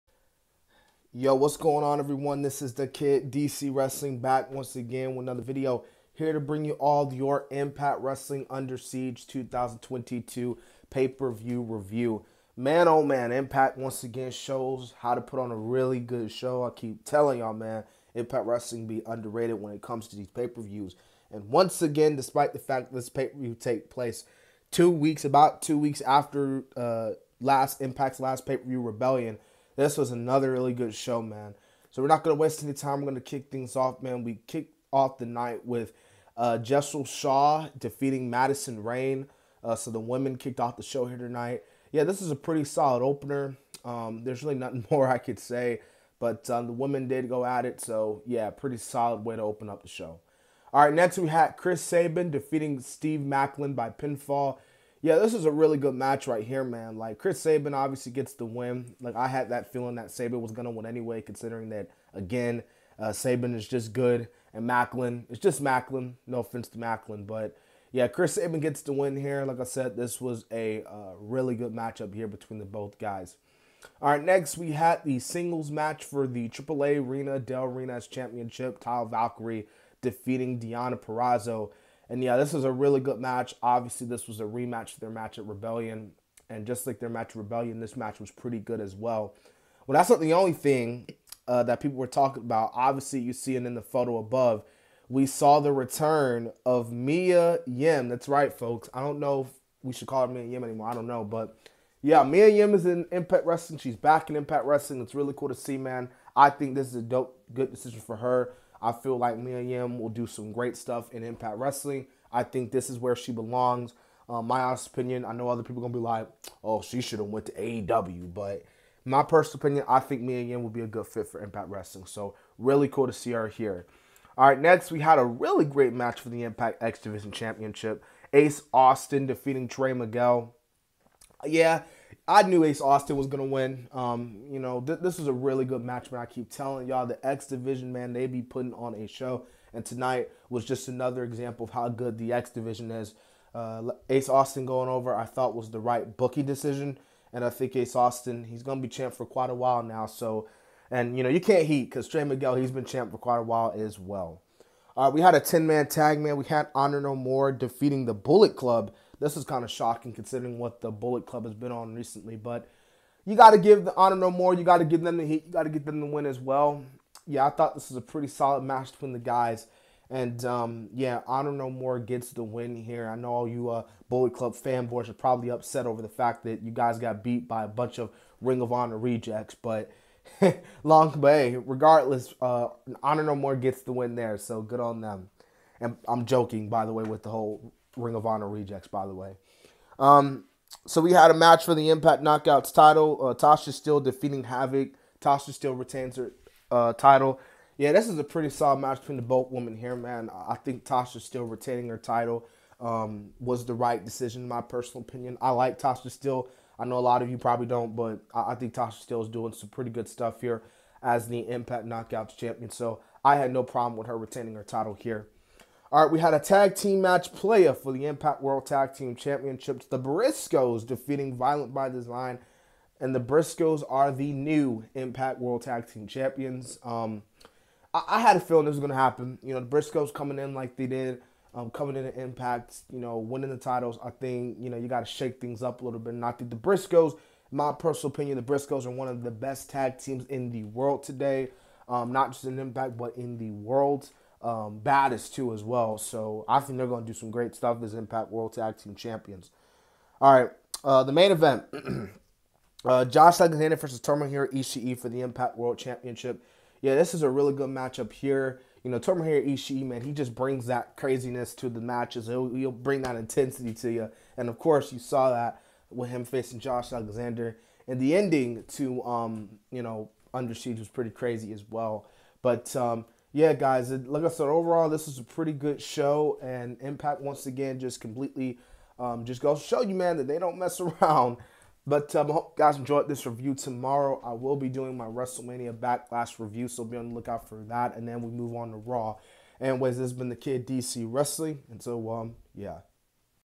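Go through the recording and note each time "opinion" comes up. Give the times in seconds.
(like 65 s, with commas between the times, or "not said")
114 s, 119 s, 205 s, 238 s.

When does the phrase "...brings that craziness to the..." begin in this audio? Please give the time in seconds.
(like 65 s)
260 s.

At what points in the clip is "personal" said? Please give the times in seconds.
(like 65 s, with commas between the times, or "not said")
119 s, 204 s, 237 s.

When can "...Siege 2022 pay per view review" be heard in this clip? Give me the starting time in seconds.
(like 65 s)
8 s.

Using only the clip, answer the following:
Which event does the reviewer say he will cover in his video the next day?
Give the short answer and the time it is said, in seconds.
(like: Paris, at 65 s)
WrestleMania Backlash, at 285 s.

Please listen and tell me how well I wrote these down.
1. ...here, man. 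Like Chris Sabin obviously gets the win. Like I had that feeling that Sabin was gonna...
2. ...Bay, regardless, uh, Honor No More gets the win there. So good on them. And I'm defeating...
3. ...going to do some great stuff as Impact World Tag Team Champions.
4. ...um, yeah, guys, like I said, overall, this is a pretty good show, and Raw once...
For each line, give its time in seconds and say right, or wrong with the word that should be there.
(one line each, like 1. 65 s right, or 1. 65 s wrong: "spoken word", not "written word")
1. 56 s right
2. 181 s wrong: "joking", not "defeating"
3. 246 s right
4. 272 s wrong: "Impact", not "Raw".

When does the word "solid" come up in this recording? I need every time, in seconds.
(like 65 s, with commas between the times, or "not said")
42 s, 48 s, 168 s, 198 s.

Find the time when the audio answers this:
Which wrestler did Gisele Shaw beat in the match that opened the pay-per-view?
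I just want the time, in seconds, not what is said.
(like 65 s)
38 s.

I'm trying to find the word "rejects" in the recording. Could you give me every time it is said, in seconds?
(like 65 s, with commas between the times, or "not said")
178 s, 188 s.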